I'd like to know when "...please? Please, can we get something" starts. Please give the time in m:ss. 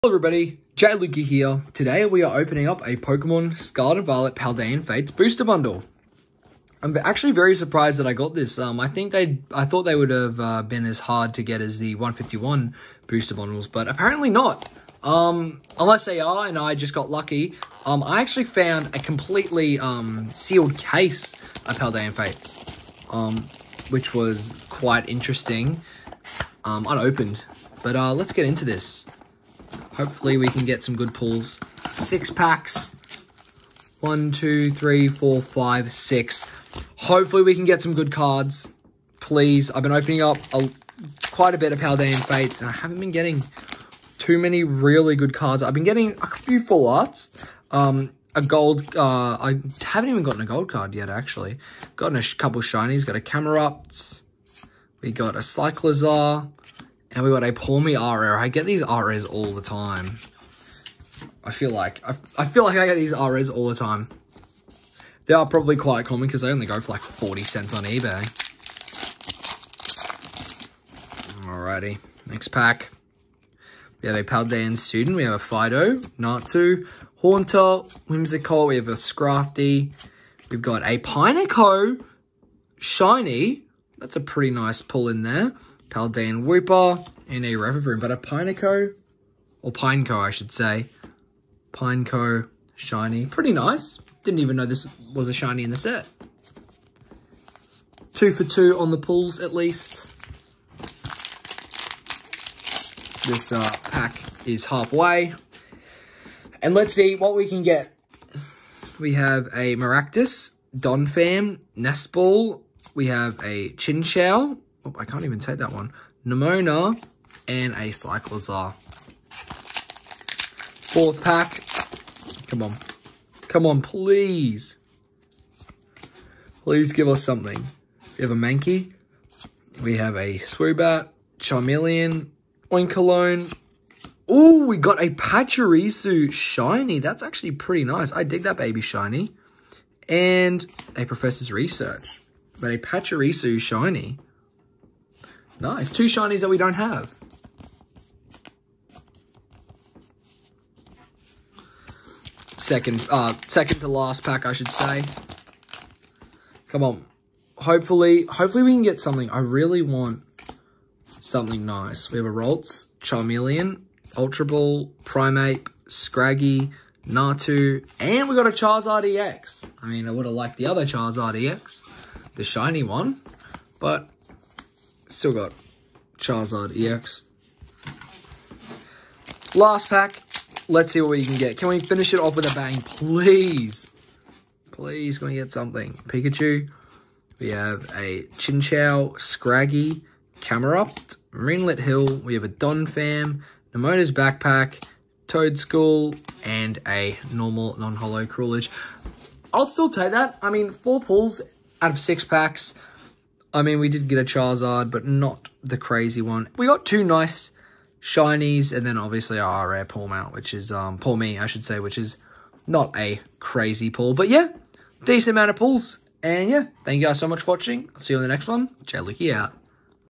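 3:02.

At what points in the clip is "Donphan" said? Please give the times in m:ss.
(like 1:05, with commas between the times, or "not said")
1:50, 3:12.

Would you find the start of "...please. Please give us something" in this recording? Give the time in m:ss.
2:03.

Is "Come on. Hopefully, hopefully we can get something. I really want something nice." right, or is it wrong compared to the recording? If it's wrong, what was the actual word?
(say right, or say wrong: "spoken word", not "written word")
right.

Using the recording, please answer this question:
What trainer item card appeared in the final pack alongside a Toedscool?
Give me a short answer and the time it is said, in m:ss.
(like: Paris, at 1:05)
Nemona's Backpack, at 3:13.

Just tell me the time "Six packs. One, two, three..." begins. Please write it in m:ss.
0:31.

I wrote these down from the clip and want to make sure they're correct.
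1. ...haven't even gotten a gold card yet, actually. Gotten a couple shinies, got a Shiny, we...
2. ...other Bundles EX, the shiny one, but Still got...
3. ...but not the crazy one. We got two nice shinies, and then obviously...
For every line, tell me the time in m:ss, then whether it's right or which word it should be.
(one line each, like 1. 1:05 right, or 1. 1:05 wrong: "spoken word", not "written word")
1. 0:49 wrong: "Camerupt", not "Shiny"
2. 2:50 wrong: "Charizard", not "Bundles"
3. 3:24 right.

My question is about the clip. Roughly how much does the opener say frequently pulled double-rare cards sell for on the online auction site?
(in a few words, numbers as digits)
40 cents.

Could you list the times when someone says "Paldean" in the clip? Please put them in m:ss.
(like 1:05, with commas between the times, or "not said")
0:04, 0:21, 0:41, 1:14, 1:25.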